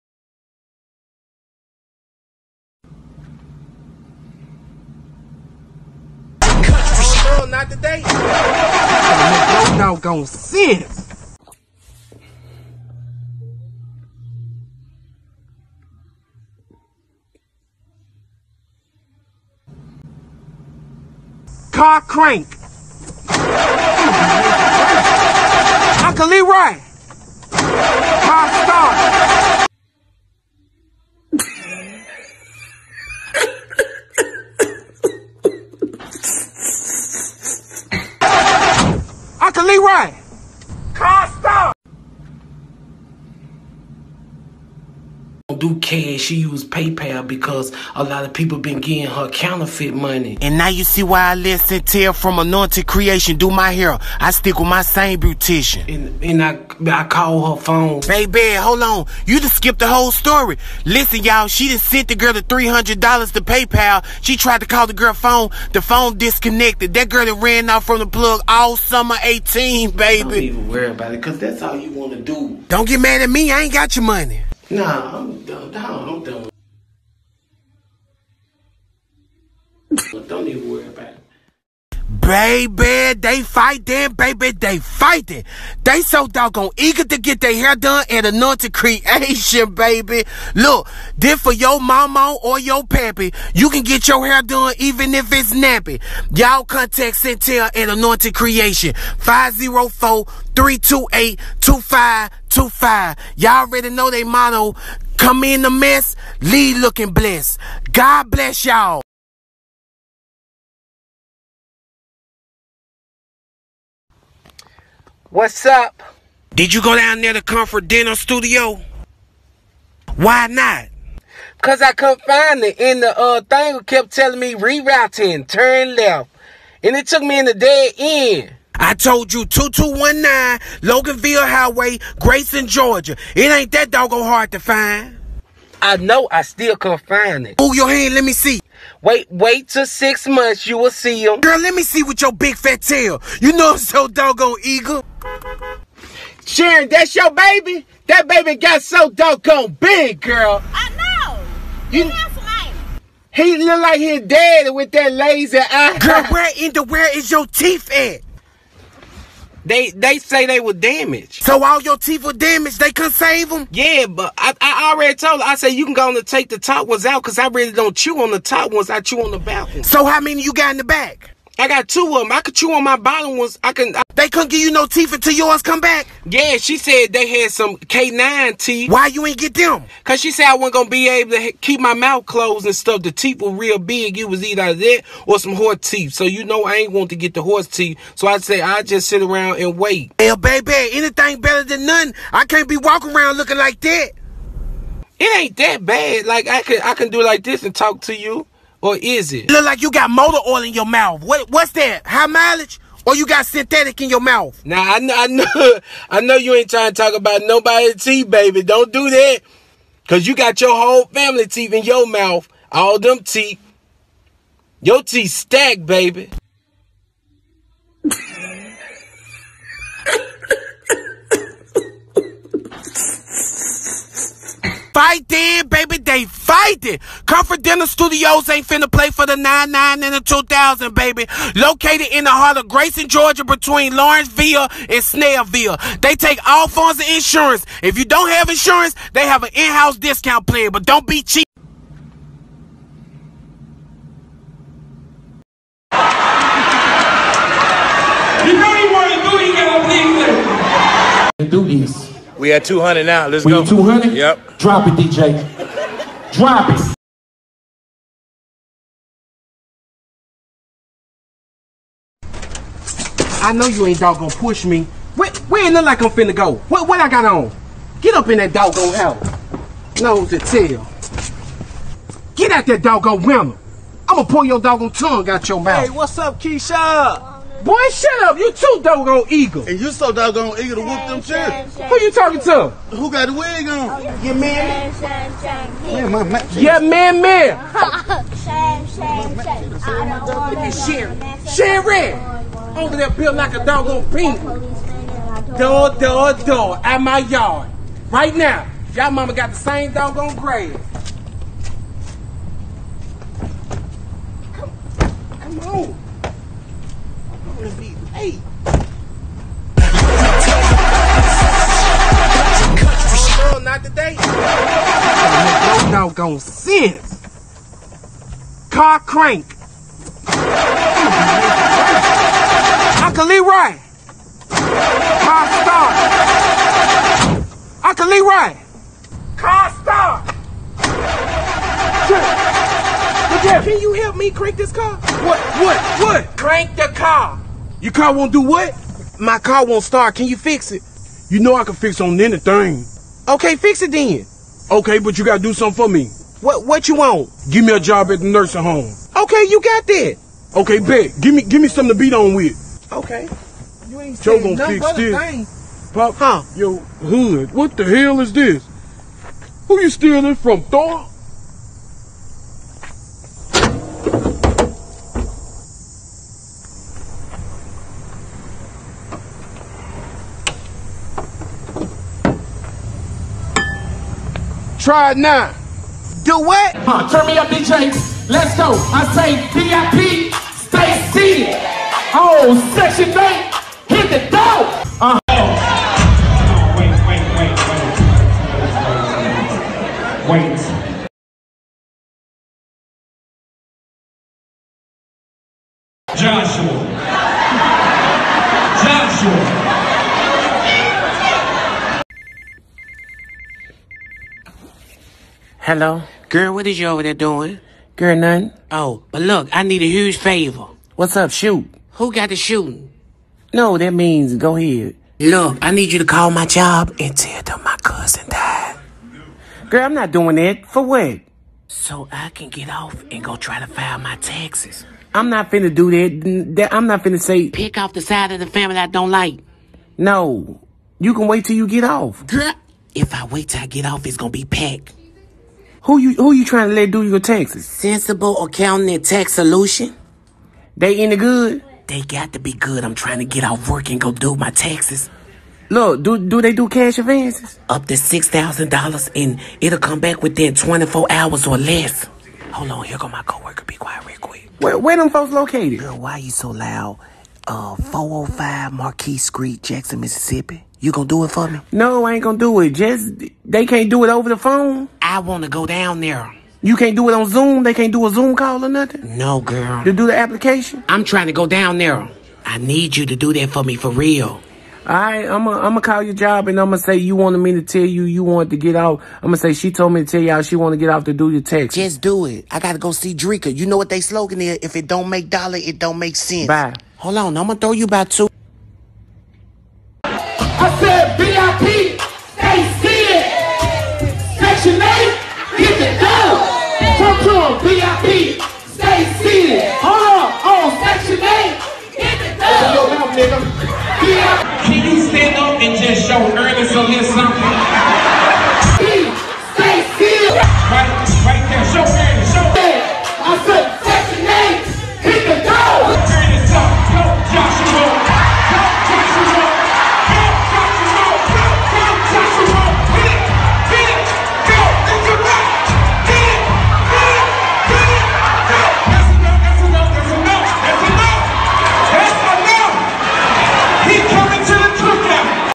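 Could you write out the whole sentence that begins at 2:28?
That baby got so doggone big, girl.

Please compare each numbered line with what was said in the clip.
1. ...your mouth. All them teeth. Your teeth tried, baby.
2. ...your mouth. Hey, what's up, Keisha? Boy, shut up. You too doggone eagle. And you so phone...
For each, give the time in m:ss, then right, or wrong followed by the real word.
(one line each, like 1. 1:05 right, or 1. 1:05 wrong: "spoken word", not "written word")
1. 3:31 wrong: "stacked", not "tried"
2. 4:35 wrong: "doggone", not "phone".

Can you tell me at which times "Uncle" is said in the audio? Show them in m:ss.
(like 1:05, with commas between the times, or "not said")
0:26, 5:23, 5:27.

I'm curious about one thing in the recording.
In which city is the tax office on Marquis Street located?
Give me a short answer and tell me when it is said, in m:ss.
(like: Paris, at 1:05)
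Jackson, Mississippi, at 7:39.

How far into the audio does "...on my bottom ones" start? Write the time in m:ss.
2:52.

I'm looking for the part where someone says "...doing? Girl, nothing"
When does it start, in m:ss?
6:47.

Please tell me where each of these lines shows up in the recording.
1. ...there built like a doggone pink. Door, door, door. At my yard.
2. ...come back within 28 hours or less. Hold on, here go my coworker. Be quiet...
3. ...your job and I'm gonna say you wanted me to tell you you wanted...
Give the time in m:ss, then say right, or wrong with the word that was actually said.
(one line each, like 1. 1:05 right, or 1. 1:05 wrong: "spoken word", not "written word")
1. 4:52 right
2. 7:29 wrong: "24", not "28"
3. 7:56 right.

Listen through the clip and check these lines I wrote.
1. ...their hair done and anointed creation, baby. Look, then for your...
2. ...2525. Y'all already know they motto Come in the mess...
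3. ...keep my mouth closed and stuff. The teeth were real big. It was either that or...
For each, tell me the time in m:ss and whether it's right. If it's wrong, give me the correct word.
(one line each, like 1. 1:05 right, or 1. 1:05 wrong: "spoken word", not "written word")
1. 1:27 right
2. 1:41 right
3. 3:01 right.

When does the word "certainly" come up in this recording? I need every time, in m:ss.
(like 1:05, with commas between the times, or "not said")
not said.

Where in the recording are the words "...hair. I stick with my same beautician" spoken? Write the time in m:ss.
0:53.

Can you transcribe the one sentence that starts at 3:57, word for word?
If you don't have insurance, they have an in-house discount plan, but don't be cheap.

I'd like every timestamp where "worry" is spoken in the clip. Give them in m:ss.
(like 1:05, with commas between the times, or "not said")
1:10, 1:20.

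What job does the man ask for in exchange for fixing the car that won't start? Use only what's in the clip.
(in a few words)
a job at the nursing home.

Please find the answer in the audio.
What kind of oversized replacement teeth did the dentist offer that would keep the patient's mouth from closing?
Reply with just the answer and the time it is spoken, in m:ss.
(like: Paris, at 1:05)
canine teeth, at 2:57.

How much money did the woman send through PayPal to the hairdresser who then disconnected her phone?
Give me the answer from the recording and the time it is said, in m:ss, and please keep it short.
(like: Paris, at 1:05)
$300, at 1:02.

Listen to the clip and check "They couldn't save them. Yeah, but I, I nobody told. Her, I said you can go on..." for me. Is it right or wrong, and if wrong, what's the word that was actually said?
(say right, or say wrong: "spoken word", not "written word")
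wrong: "already", not "nobody".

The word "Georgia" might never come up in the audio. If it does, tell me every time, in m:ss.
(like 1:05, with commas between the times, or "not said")
2:12, 3:53.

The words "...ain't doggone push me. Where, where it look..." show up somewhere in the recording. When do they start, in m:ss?
4:23.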